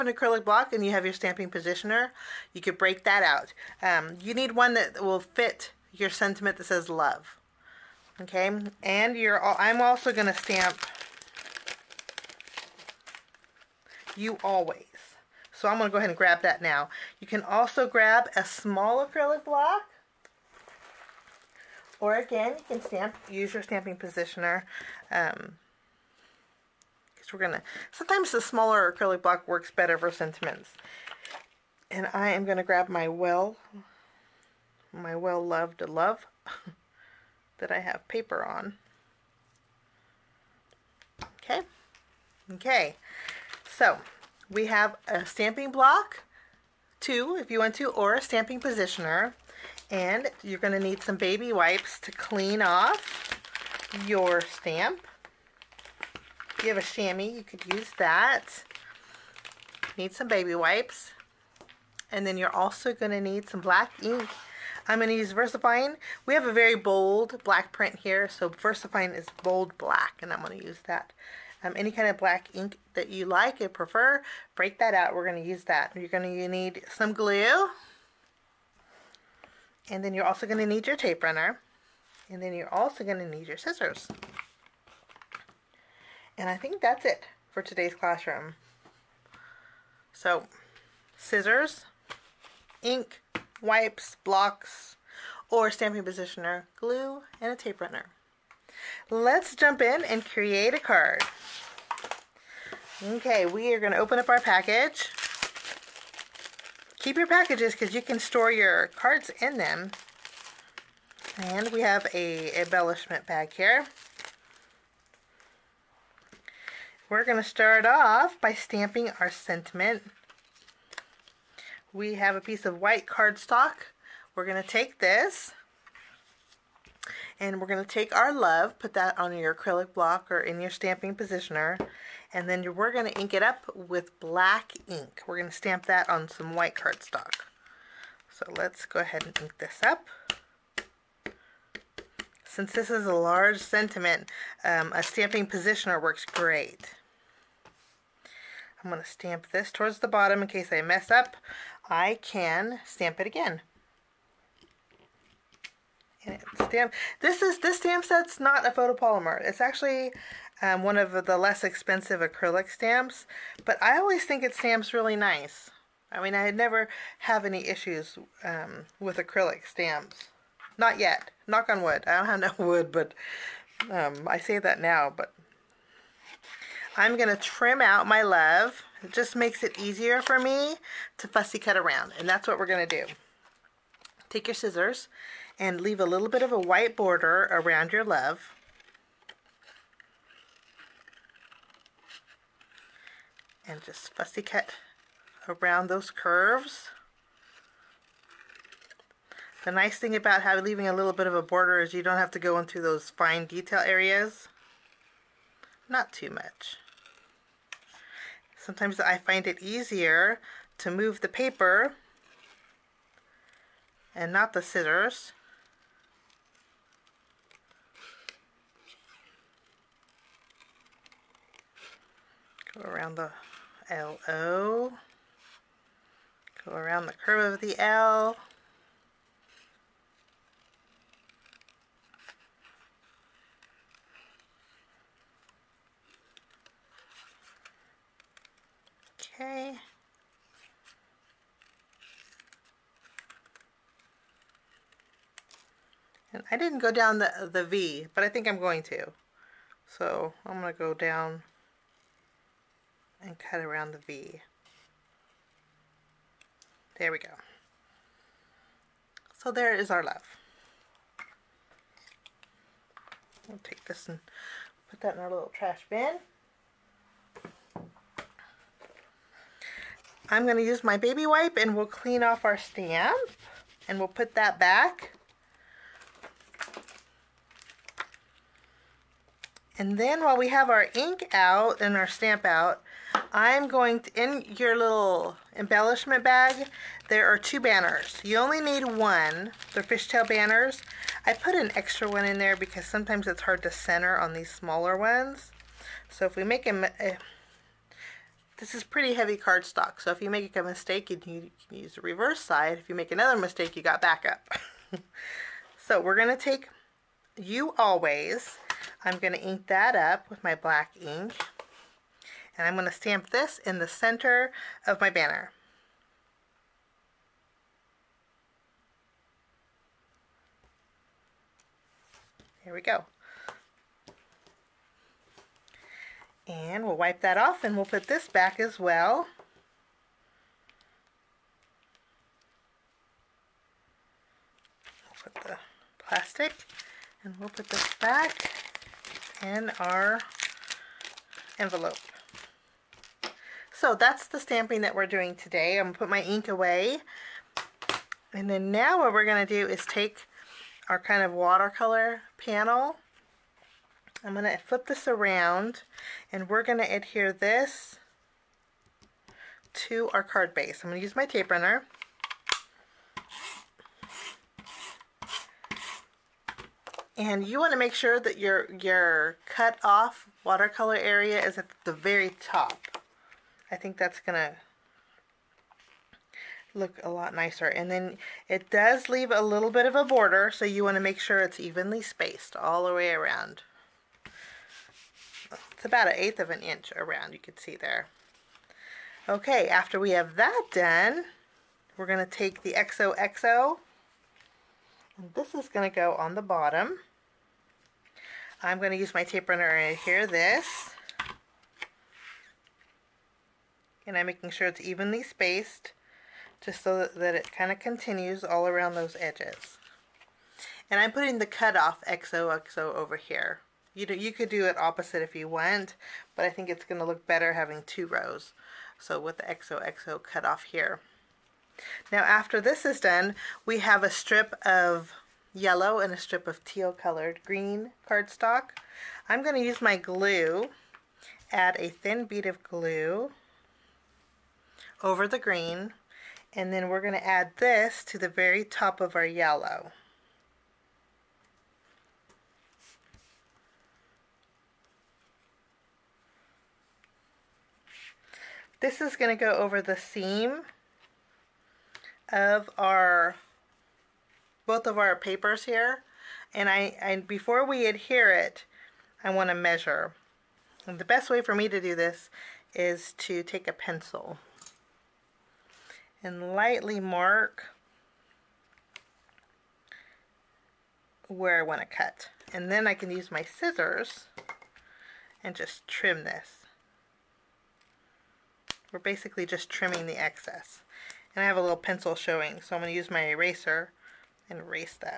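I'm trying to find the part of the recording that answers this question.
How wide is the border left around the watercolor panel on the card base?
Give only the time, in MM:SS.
06:26.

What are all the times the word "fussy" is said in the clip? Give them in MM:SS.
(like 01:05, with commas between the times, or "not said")
03:01, 03:14.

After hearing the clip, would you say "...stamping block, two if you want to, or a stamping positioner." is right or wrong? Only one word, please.
right.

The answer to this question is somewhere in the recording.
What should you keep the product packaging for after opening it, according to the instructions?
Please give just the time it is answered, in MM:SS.
01:48.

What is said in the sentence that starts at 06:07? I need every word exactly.
And you want to make sure that your, your cut off watercolor area is at the very top.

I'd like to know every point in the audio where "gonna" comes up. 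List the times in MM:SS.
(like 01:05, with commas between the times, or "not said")
00:27, 00:32.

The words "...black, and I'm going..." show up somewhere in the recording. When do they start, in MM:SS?
01:09.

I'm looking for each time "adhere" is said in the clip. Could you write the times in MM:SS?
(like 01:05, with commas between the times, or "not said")
05:56, 06:39, 07:37.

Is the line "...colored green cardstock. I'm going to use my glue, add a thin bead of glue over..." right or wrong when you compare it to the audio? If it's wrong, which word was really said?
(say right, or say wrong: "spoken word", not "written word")
right.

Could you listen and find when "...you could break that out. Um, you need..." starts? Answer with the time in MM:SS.
00:02.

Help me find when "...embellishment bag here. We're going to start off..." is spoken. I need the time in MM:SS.
01:52.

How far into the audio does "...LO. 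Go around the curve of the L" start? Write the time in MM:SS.
03:43.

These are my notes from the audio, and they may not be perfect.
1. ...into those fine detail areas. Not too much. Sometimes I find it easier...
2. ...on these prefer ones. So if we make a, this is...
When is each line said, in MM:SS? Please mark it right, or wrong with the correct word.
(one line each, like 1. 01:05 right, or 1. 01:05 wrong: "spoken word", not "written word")
1. 03:22 right
2. 04:54 wrong: "smaller", not "prefer".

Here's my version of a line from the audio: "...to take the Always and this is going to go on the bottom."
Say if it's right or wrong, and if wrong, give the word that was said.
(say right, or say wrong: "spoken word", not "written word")
wrong: "XOXO", not "Always".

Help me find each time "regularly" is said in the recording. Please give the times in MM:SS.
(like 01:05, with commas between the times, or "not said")
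not said.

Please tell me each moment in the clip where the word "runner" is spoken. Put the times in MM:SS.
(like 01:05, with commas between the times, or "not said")
01:21, 01:37, 06:01, 06:39.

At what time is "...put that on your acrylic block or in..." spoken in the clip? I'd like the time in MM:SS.
02:08.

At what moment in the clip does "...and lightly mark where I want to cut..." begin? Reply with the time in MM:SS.
07:46.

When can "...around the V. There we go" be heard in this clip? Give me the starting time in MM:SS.
04:13.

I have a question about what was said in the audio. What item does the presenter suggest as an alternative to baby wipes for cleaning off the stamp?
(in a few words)
chamois.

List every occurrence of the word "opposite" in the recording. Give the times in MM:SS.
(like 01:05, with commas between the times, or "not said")
06:54.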